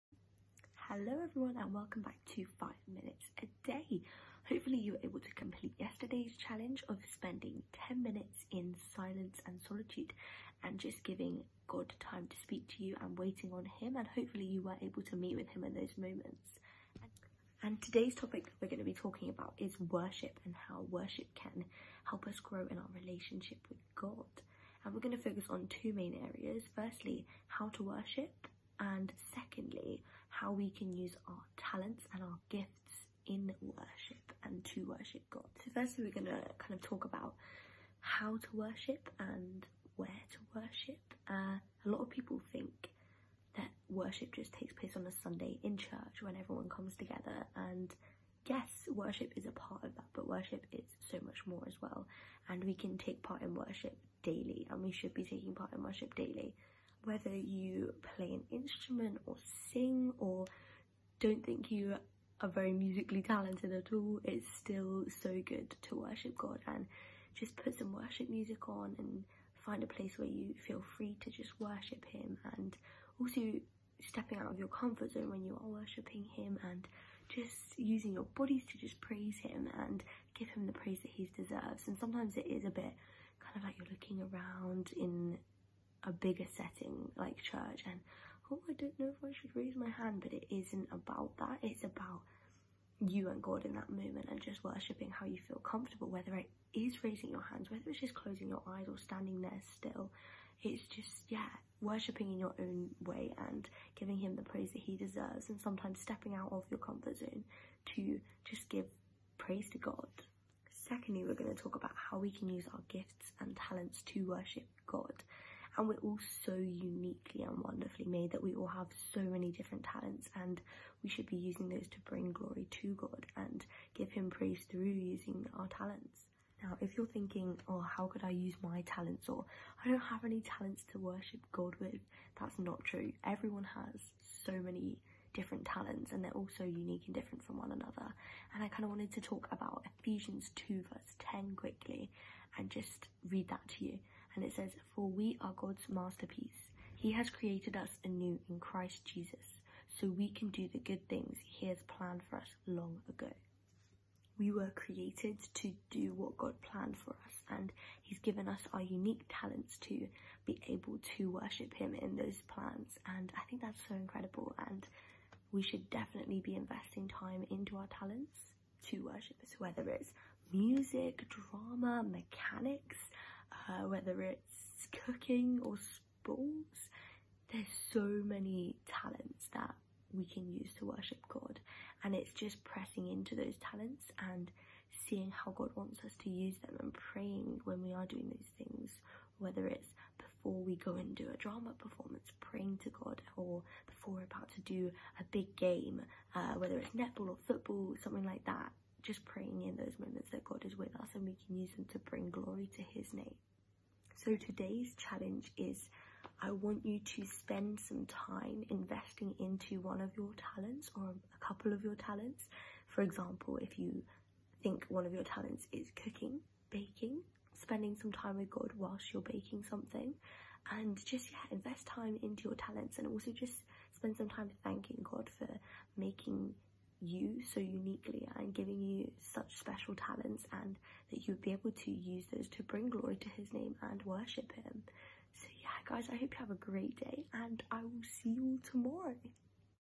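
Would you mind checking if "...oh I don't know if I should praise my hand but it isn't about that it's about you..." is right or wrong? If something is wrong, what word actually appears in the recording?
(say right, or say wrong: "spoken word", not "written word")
wrong: "raise", not "praise".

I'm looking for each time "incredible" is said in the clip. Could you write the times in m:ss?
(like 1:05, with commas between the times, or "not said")
2:43.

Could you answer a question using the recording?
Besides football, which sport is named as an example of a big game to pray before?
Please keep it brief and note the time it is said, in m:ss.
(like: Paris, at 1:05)
netball, at 3:16.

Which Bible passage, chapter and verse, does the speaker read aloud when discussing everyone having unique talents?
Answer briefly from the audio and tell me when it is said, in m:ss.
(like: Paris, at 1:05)
Ephesians 2:10, at 2:20.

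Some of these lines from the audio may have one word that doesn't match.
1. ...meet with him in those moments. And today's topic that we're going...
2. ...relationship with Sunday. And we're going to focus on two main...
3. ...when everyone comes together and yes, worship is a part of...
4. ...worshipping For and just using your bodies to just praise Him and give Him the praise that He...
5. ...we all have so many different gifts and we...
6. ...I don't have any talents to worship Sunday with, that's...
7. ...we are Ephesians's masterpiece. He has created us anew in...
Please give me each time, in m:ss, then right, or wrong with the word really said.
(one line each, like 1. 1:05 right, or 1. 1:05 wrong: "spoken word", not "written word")
1. 0:15 right
2. 0:23 wrong: "God", not "Sunday"
3. 0:46 right
4. 1:15 wrong: "Him", not "For"
5. 1:58 wrong: "talents", not "gifts"
6. 2:09 wrong: "God", not "Sunday"
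7. 2:25 wrong: "God", not "Ephesians".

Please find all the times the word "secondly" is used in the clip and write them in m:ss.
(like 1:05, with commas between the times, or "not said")
0:29, 1:50.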